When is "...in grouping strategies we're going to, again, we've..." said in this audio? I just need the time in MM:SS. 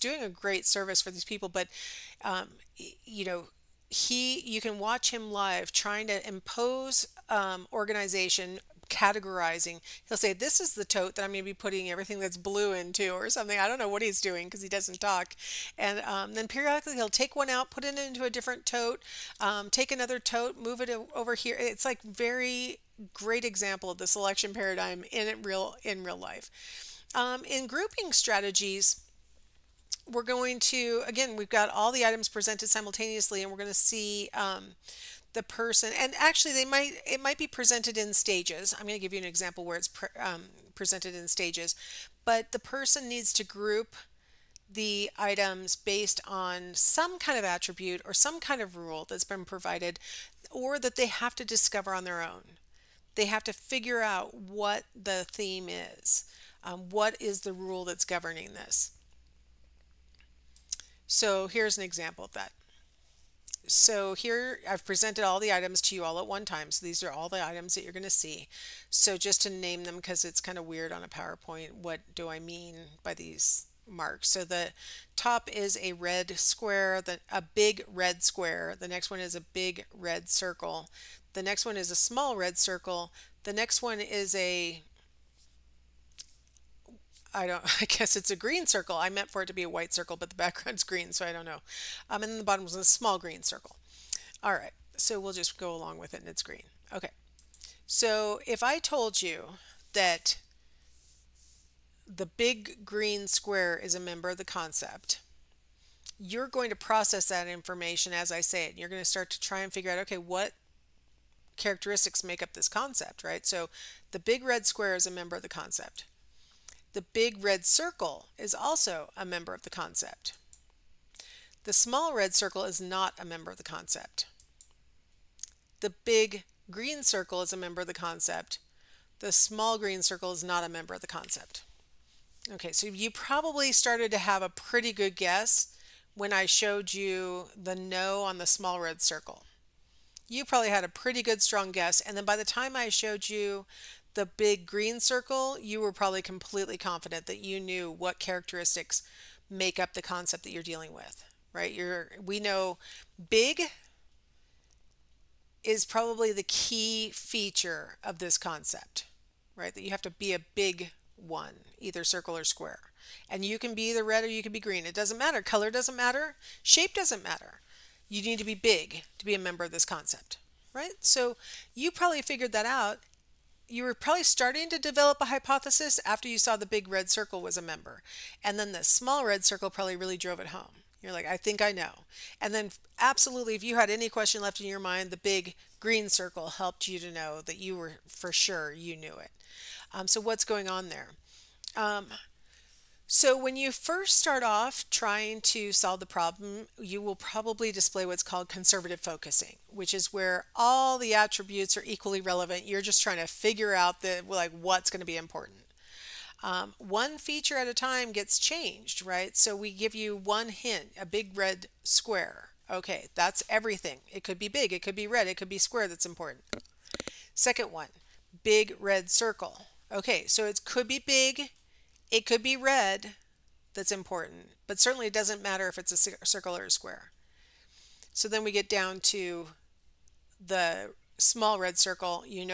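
00:27.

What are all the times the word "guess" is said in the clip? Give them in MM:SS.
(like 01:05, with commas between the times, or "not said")
01:27, 02:15, 02:21.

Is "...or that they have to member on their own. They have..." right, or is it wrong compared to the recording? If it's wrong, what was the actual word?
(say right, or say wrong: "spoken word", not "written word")
wrong: "discover", not "member".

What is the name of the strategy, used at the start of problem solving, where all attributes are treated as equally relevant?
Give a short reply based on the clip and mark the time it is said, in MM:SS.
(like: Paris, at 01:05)
Conservative focusing, at 03:18.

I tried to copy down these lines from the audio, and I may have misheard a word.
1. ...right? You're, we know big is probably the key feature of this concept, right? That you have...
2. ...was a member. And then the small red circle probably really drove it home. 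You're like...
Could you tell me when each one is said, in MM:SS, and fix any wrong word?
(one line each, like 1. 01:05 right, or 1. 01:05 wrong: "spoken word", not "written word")
1. 02:31 right
2. 02:57 right.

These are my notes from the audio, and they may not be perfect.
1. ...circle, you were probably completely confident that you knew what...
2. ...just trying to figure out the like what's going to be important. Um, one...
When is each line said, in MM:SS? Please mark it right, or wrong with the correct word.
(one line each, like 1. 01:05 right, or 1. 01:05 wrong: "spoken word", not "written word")
1. 02:24 right
2. 03:22 right.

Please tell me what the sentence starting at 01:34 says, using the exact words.
All right, so we'll just go along with it and it's green.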